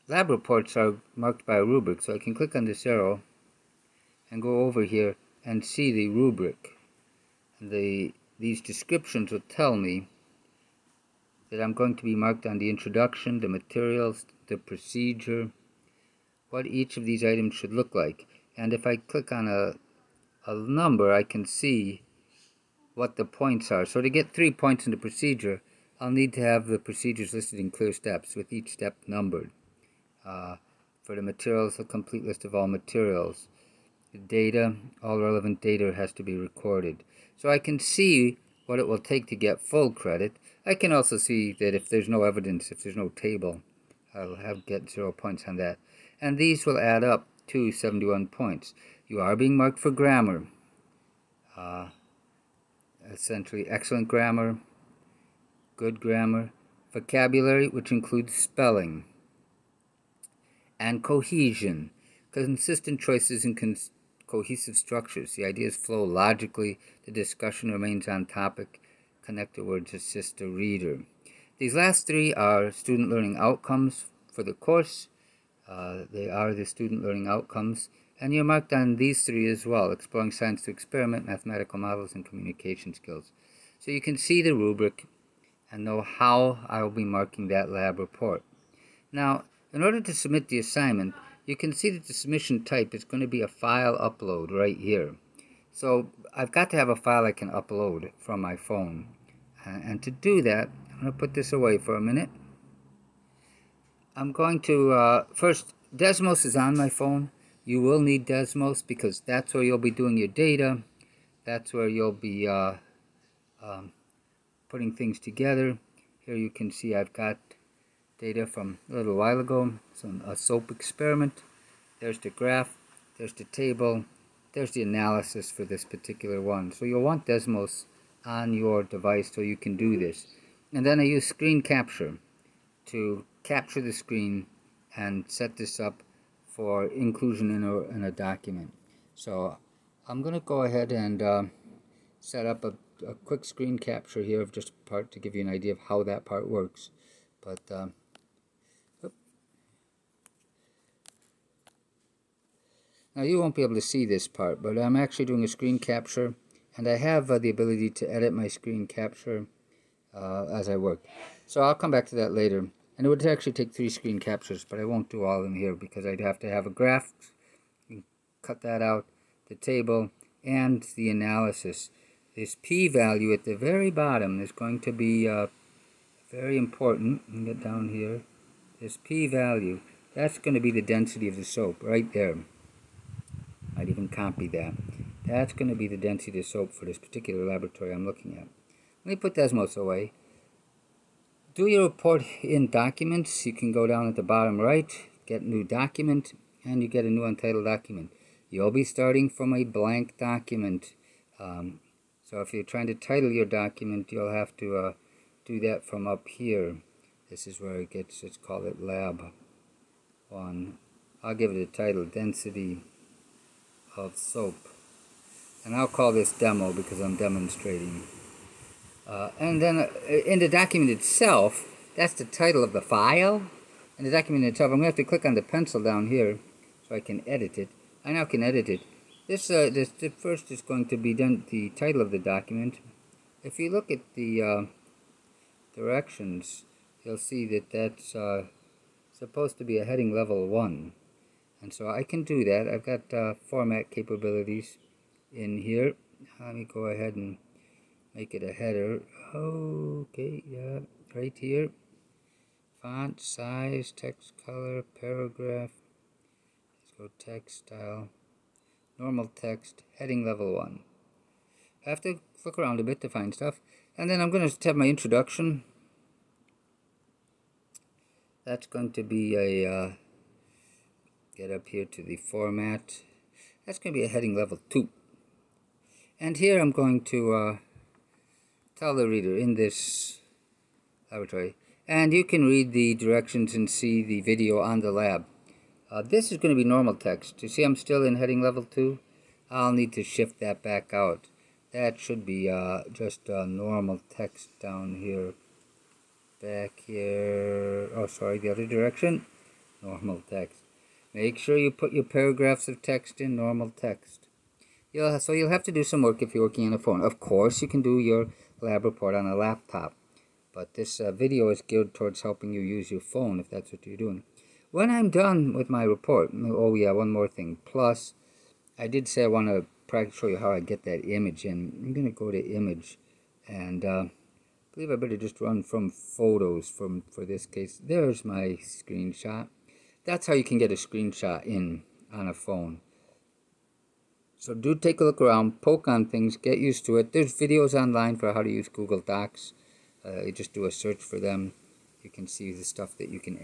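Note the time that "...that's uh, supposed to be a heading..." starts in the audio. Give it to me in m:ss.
3:57.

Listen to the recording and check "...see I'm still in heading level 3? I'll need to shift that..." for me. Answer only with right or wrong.
wrong.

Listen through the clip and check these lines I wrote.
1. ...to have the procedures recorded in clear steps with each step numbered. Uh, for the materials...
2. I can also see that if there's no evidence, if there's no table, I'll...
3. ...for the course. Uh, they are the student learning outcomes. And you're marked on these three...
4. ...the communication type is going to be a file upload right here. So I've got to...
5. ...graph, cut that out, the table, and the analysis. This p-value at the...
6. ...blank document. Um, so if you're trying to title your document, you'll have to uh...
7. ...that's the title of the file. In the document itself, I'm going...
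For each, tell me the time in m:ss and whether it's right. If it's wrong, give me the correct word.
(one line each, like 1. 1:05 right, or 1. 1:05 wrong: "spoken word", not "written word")
1. 0:26 wrong: "listed", not "recorded"
2. 0:40 right
3. 1:14 right
4. 1:32 wrong: "submission", not "communication"
5. 2:46 right
6. 3:19 right
7. 3:41 right.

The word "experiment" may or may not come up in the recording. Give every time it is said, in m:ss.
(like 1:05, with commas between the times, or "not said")
1:20, 2:00.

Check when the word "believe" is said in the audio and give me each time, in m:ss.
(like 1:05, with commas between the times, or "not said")
5:24.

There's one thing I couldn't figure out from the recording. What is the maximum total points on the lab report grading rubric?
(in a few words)
71.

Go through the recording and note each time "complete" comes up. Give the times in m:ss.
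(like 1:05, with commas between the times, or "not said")
0:31.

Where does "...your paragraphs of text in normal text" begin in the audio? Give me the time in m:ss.
5:01.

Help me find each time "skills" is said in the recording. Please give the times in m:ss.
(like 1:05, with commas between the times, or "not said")
1:22.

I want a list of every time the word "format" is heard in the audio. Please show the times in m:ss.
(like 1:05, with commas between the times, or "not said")
4:03, 4:32.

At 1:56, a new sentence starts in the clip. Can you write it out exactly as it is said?
Here you can see I've got data from a little while ago.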